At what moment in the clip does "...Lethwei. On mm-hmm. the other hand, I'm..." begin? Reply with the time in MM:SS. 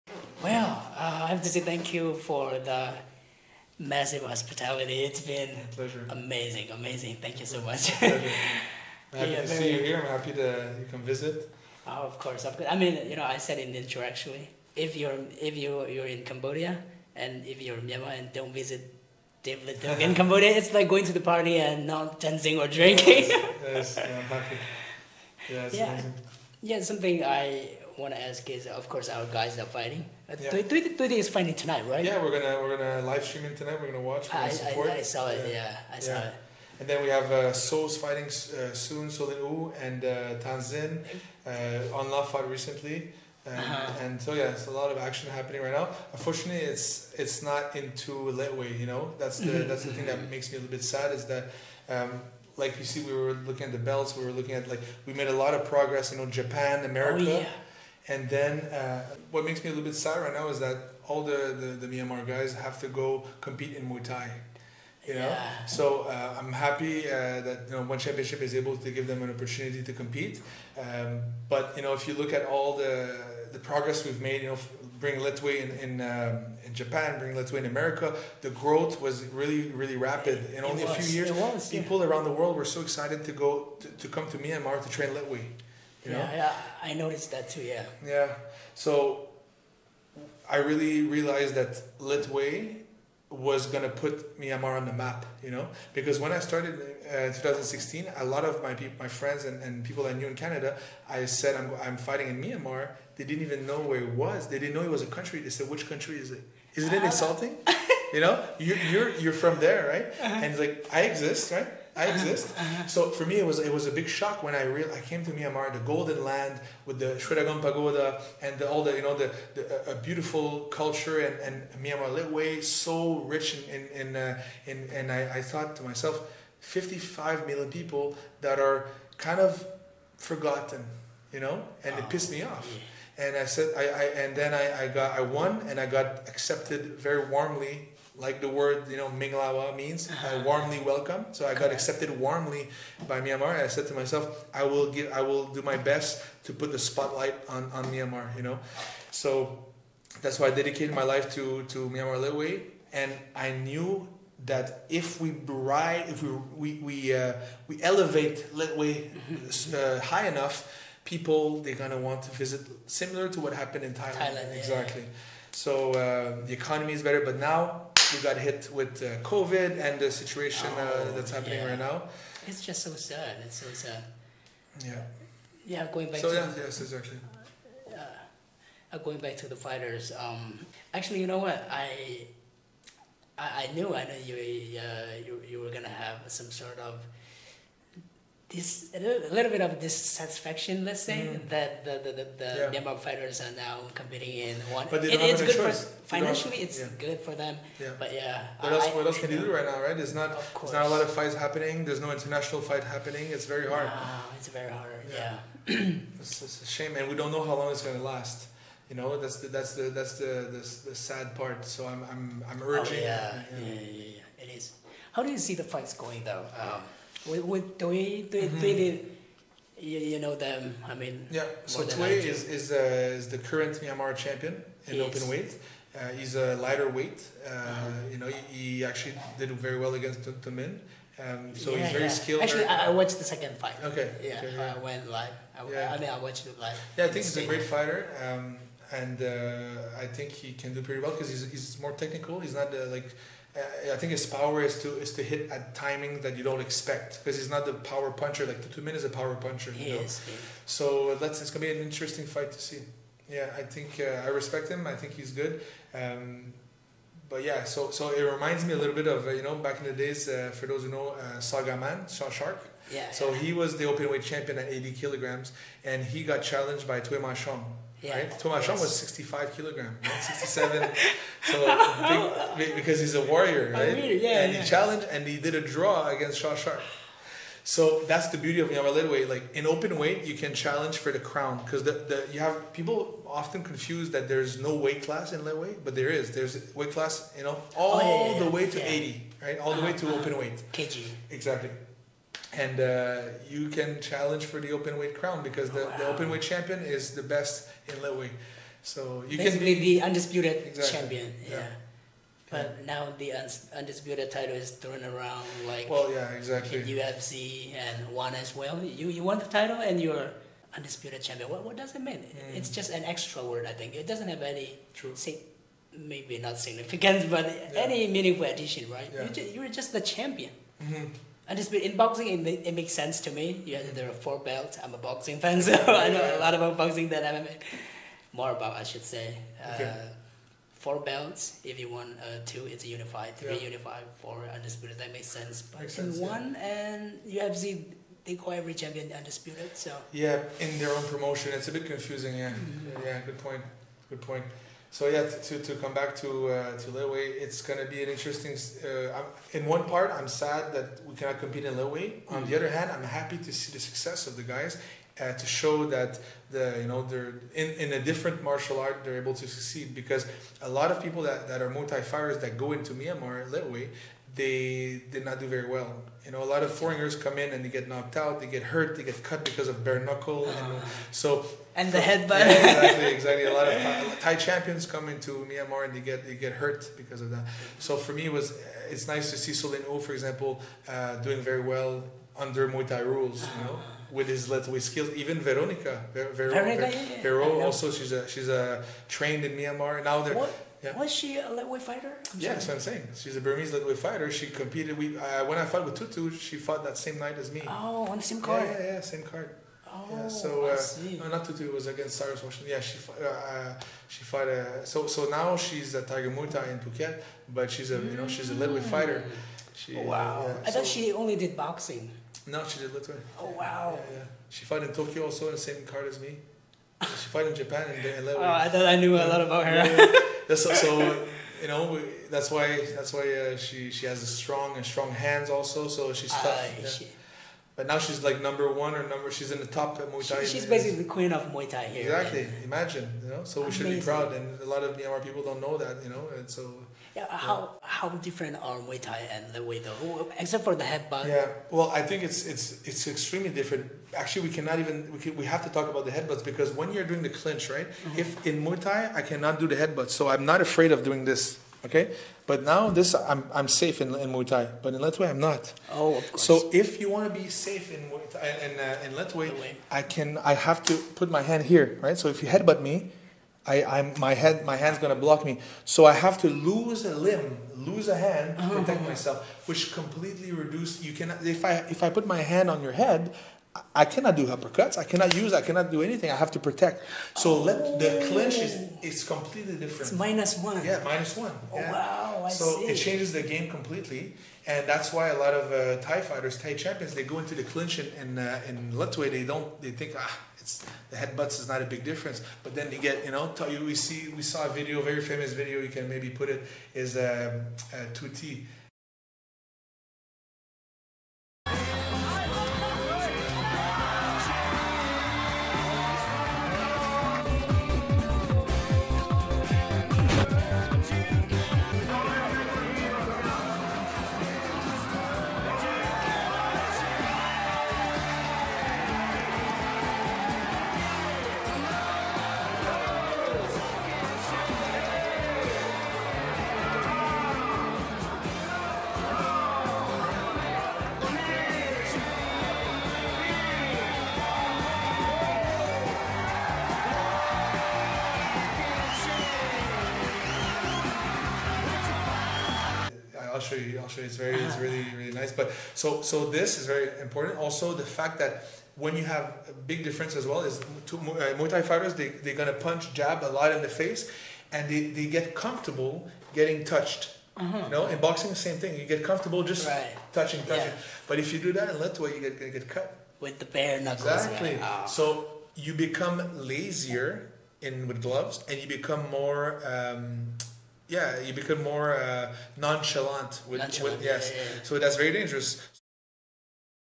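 05:51.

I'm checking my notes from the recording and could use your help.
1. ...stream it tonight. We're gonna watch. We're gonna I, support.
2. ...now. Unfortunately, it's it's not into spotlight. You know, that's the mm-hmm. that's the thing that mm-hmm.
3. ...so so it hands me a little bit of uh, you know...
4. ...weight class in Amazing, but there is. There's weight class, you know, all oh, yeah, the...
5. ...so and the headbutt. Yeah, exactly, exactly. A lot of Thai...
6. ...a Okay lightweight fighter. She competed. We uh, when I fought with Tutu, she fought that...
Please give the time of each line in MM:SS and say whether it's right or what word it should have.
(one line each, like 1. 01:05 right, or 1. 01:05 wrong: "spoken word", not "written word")
1. 00:33 right
2. 00:45 wrong: "lightweight", not "spotlight"
3. 04:17 wrong: "reminds", not "hands"
4. 04:44 wrong: "Lethwei", not "Amazing"
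5. 06:11 right
6. 06:33 wrong: "Burmese", not "Okay".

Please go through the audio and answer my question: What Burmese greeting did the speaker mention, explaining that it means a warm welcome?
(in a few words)
Minglawa.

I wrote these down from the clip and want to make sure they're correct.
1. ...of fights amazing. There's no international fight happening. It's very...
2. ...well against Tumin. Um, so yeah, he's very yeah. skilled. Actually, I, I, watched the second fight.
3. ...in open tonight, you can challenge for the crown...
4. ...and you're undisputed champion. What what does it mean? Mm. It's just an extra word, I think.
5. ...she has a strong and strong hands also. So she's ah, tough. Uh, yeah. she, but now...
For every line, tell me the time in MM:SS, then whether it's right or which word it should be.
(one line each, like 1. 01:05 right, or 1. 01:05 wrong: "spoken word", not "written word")
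1. 03:21 wrong: "happening", not "amazing"
2. 03:49 right
3. 04:39 wrong: "weight", not "tonight"
4. 05:09 right
5. 07:03 right.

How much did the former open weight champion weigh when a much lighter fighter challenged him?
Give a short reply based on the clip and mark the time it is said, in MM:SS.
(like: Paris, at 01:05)
80 kilograms, at 04:24.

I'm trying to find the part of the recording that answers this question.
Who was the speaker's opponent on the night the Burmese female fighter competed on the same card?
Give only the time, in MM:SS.
06:42.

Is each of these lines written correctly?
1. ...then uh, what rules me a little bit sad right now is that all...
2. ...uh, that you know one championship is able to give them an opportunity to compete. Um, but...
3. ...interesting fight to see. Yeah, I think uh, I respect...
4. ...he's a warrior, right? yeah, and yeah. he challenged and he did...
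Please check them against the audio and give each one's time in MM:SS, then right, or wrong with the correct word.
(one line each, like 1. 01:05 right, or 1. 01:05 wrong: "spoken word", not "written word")
1. 00:58 wrong: "makes", not "rules"
2. 01:07 right
3. 04:11 right
4. 04:32 right.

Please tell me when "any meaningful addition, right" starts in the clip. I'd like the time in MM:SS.
05:17.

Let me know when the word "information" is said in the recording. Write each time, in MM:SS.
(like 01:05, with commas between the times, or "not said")
not said.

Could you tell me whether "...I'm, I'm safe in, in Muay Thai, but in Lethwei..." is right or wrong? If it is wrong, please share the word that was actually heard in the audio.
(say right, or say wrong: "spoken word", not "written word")
right.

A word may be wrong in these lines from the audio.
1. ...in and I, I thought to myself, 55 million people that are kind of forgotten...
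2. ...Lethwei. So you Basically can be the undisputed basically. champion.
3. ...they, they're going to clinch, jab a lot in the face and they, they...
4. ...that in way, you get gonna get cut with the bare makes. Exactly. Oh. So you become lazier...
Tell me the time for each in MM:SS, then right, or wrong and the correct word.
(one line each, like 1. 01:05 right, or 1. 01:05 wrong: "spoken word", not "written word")
1. 02:04 right
2. 04:57 wrong: "exactly", not "basically"
3. 09:12 wrong: "punch", not "clinch"
4. 09:21 wrong: "knuckles", not "makes".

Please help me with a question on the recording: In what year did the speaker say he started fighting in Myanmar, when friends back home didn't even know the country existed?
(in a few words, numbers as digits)
2016.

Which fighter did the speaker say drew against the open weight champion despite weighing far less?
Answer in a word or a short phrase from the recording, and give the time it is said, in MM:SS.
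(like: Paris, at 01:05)
Tui Machon, at 04:27.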